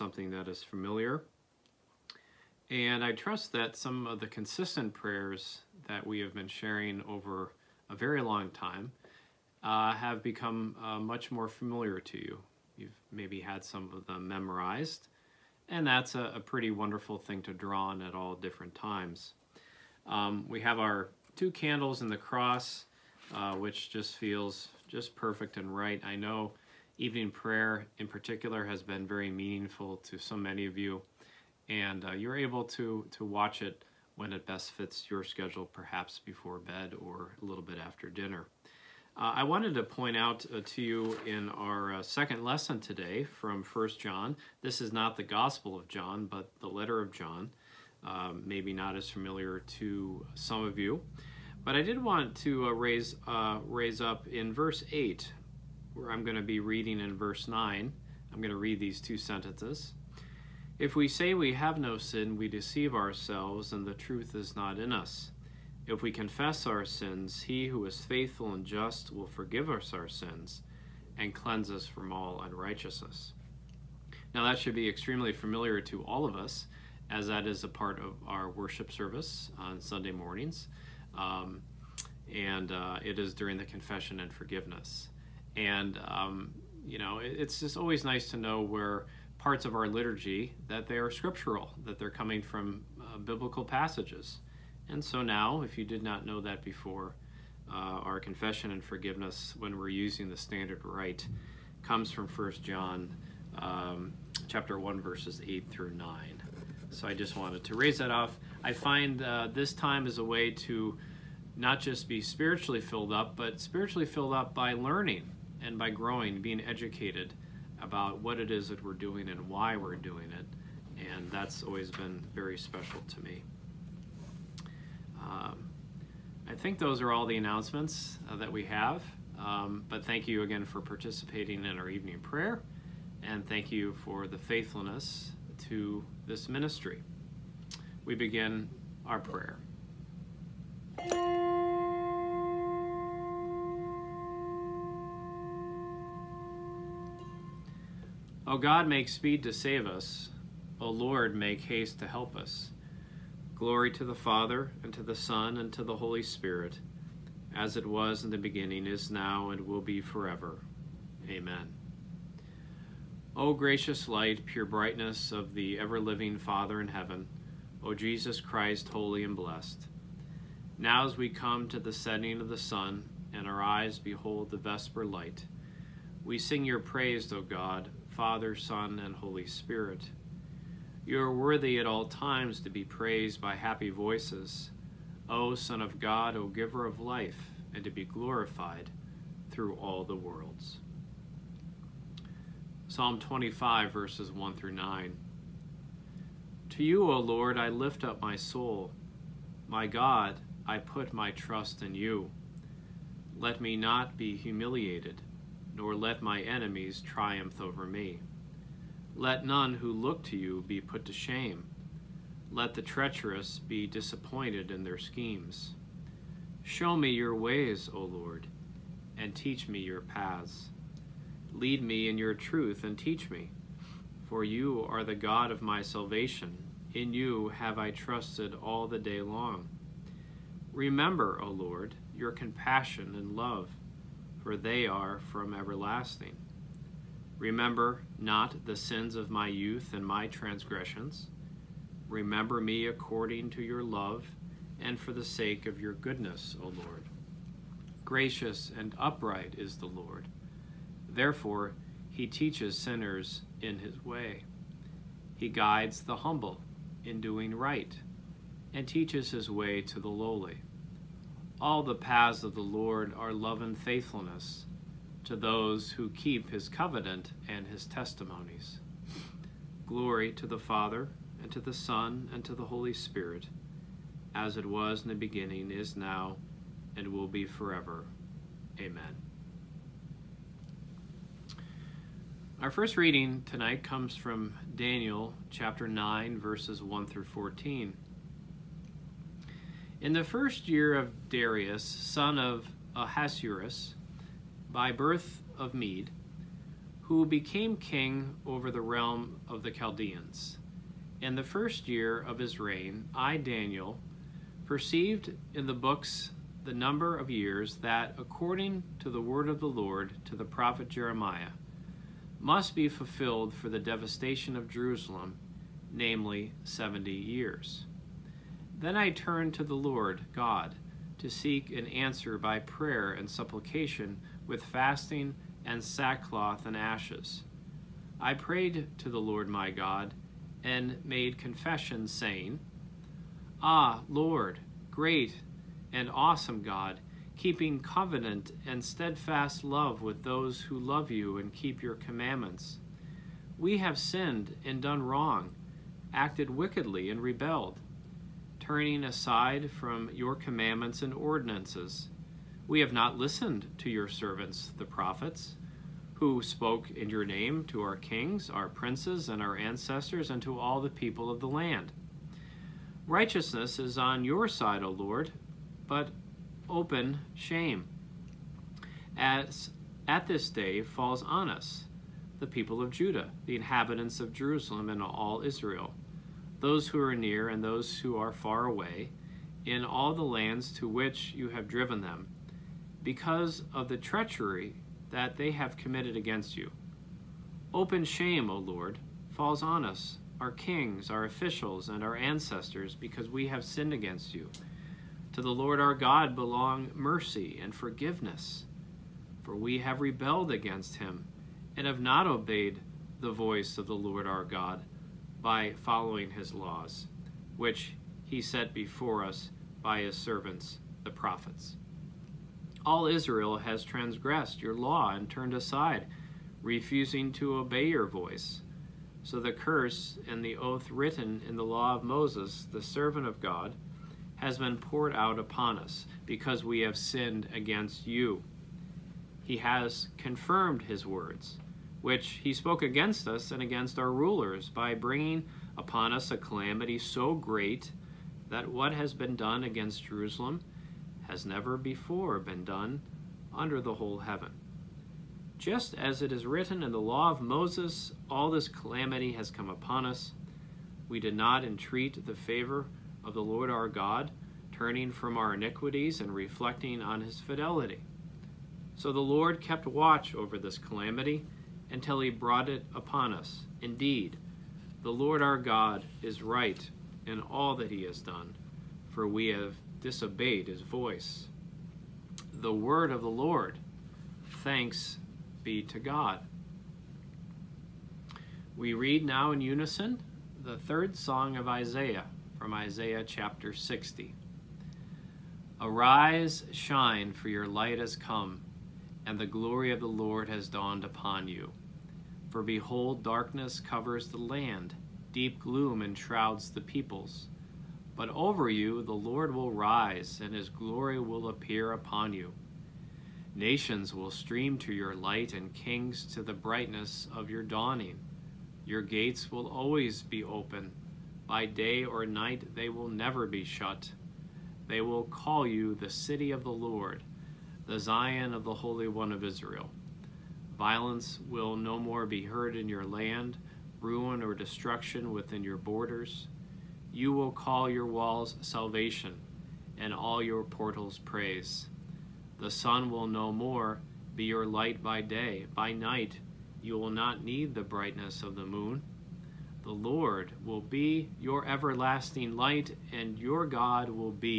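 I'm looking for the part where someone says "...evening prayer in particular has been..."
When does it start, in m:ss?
0:26.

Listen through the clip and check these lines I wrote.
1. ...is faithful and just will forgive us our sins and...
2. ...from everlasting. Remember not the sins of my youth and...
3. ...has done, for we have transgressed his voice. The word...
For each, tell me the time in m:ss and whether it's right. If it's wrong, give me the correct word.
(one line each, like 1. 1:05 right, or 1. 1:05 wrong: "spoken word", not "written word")
1. 1:07 right
2. 3:55 right
3. 7:48 wrong: "disobeyed", not "transgressed".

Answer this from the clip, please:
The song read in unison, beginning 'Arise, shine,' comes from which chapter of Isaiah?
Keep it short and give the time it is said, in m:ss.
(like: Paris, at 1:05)
chapter 60, at 8:02.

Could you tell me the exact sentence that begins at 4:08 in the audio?
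Gracious and upright is the Lord.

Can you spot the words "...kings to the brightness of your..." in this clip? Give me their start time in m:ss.
8:25.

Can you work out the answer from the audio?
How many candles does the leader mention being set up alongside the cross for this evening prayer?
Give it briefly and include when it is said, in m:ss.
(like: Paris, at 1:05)
2, at 0:21.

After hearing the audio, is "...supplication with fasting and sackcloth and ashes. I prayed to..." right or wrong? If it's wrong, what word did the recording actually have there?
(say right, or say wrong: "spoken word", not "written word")
right.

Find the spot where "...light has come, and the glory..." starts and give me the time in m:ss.
8:07.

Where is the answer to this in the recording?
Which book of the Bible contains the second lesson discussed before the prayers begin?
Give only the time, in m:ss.
0:43.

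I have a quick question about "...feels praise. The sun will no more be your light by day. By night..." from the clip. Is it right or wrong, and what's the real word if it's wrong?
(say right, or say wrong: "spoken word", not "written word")
wrong: "portals", not "feels".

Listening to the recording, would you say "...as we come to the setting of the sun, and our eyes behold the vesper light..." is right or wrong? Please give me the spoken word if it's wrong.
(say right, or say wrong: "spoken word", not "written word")
right.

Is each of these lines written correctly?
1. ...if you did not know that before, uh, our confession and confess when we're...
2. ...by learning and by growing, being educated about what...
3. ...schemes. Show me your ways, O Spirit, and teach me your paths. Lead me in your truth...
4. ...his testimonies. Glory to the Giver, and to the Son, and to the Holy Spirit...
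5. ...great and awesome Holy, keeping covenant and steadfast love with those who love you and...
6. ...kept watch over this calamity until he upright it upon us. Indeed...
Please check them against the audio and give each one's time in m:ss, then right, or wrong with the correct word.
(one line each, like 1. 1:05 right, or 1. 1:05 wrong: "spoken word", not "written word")
1. 1:35 wrong: "forgiveness", not "confess"
2. 1:54 right
3. 3:34 wrong: "Lord", not "Spirit"
4. 4:27 wrong: "Father", not "Giver"
5. 5:34 wrong: "God", not "Holy"
6. 7:39 wrong: "brought", not "upright".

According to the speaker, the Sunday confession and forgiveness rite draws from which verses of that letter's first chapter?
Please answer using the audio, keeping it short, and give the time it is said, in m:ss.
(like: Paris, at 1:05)
verses 8 through 9, at 1:45.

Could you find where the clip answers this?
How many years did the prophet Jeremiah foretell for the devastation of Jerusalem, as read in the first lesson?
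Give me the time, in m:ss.
5:16.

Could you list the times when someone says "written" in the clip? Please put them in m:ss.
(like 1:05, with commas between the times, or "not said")
7:00, 7:26.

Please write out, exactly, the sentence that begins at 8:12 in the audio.
For behold, darkness covers the land, deep gloom enshrouds the peoples.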